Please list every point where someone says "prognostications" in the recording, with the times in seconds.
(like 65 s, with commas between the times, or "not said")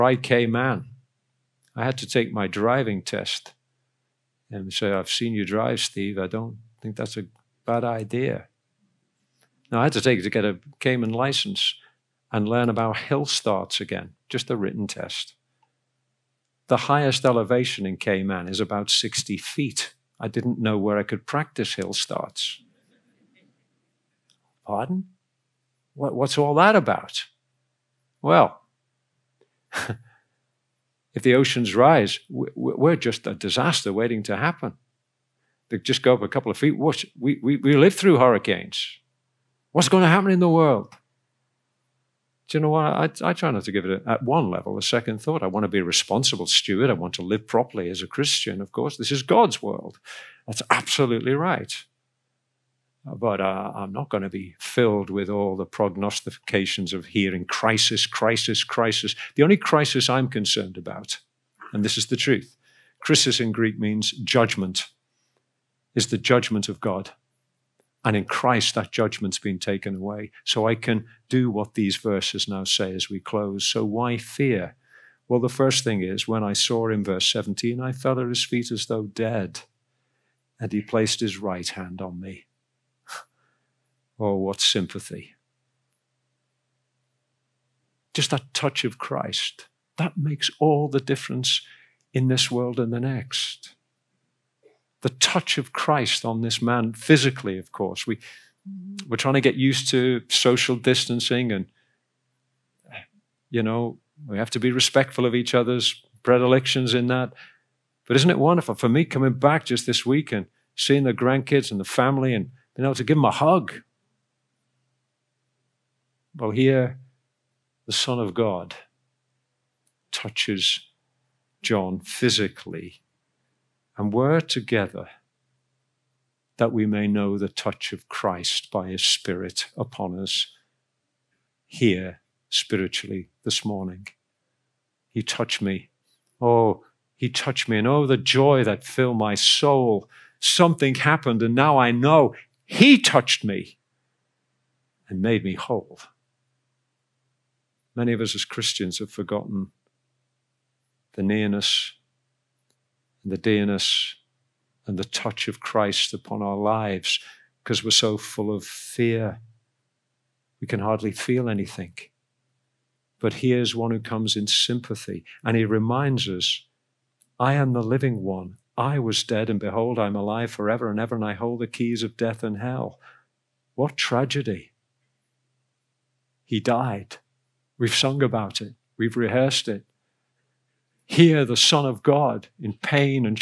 55 s.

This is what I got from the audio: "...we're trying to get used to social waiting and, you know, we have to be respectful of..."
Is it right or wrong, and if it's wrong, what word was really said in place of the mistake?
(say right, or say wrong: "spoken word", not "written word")
wrong: "distancing", not "waiting".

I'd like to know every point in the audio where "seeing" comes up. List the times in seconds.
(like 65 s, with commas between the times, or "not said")
110 s.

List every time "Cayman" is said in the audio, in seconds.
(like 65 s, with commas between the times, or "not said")
0 s, 10 s, 17 s.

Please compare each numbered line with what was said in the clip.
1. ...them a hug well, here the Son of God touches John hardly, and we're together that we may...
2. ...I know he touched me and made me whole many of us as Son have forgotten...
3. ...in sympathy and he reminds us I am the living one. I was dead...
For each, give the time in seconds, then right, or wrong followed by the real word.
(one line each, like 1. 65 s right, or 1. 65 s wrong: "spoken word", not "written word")
1. 113 s wrong: "physically", not "hardly"
2. 141 s wrong: "Christians", not "Son"
3. 164 s right.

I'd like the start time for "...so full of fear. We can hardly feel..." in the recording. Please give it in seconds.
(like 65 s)
157 s.